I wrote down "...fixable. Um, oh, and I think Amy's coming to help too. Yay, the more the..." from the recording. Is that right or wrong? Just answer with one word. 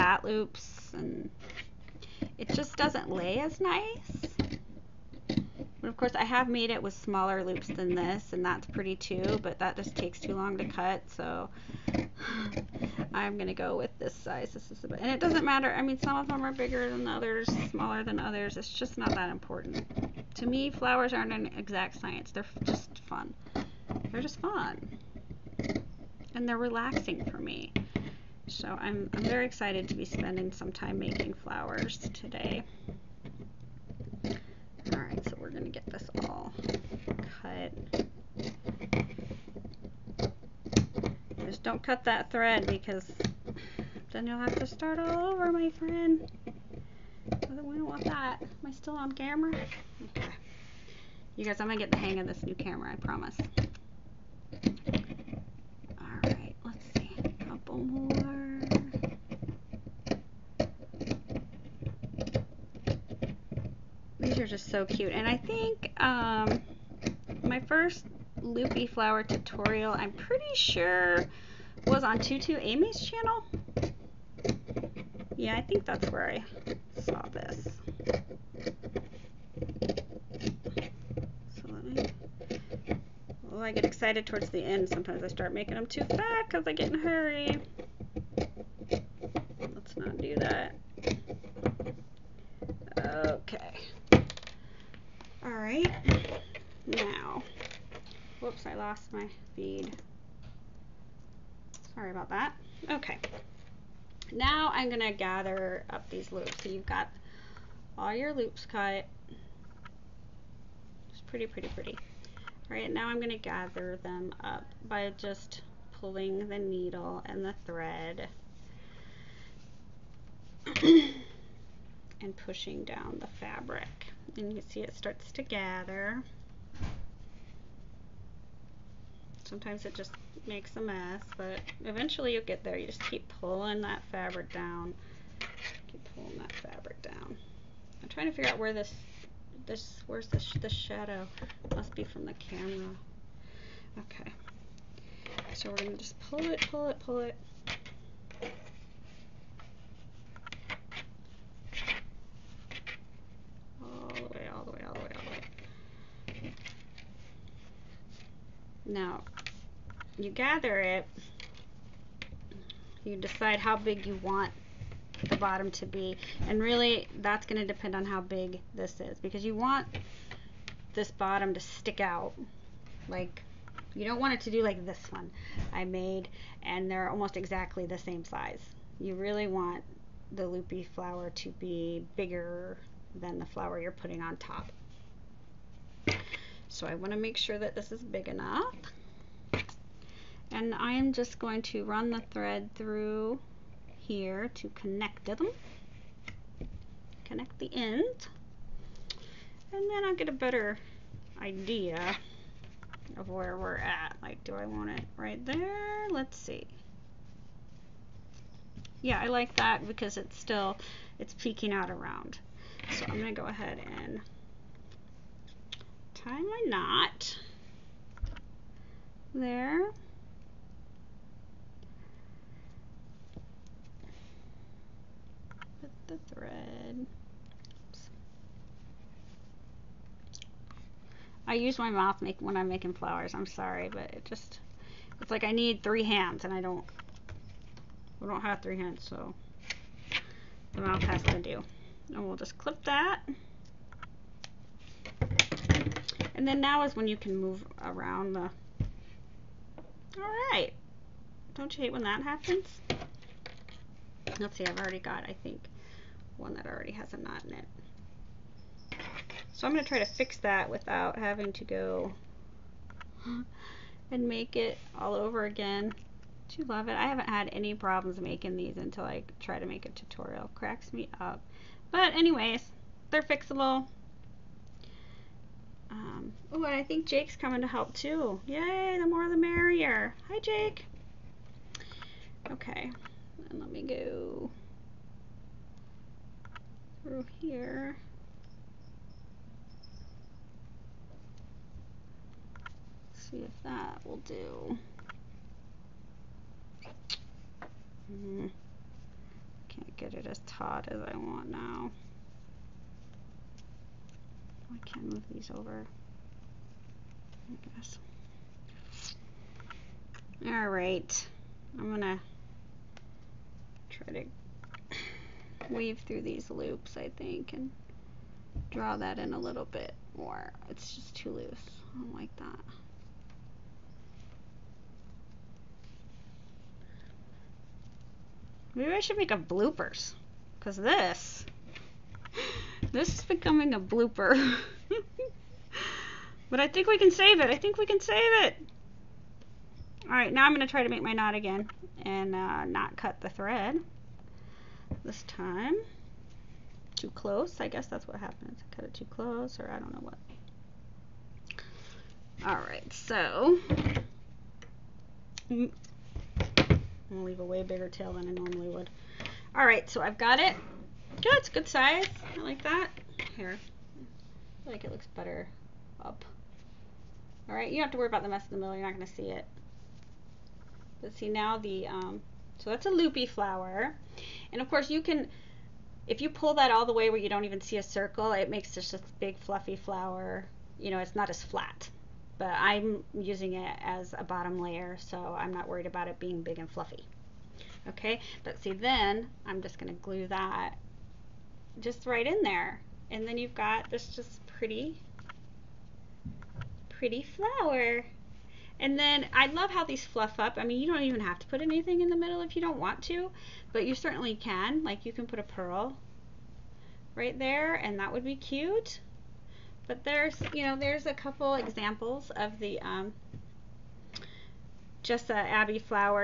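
wrong.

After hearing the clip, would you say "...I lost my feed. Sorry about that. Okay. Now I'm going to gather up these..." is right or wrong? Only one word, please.
right.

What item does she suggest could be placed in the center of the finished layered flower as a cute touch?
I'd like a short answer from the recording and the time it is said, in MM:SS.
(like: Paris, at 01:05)
A pearl, at 06:45.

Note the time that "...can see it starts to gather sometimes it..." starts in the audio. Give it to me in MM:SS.
02:04.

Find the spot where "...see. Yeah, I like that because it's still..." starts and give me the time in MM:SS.
03:26.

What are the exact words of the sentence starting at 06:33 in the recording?
And then you've got this just pretty, pretty flower.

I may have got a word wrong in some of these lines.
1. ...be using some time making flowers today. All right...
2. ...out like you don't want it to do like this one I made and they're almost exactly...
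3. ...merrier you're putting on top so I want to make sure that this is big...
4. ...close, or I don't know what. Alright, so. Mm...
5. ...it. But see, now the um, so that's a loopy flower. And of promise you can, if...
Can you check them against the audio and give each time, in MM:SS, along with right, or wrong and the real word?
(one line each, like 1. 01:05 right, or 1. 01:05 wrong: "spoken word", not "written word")
1. 00:29 wrong: "spending", not "using"
2. 02:52 right
3. 03:03 wrong: "flower", not "merrier"
4. 05:49 right
5. 06:09 wrong: "course", not "promise".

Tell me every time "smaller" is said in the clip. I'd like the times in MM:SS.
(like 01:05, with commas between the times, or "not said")
00:06, 00:17.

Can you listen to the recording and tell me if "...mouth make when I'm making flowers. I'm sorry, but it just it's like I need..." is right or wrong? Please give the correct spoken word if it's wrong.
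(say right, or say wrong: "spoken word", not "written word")
right.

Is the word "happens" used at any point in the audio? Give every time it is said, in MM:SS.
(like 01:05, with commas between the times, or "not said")
04:12, 05:48.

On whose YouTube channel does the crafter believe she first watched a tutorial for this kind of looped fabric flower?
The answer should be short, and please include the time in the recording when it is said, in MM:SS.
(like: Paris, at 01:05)
Tutu Amy, at 01:12.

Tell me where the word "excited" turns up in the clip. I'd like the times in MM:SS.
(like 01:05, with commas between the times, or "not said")
00:29, 01:23.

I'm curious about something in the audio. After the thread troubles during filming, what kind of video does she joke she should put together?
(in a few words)
Bloopers.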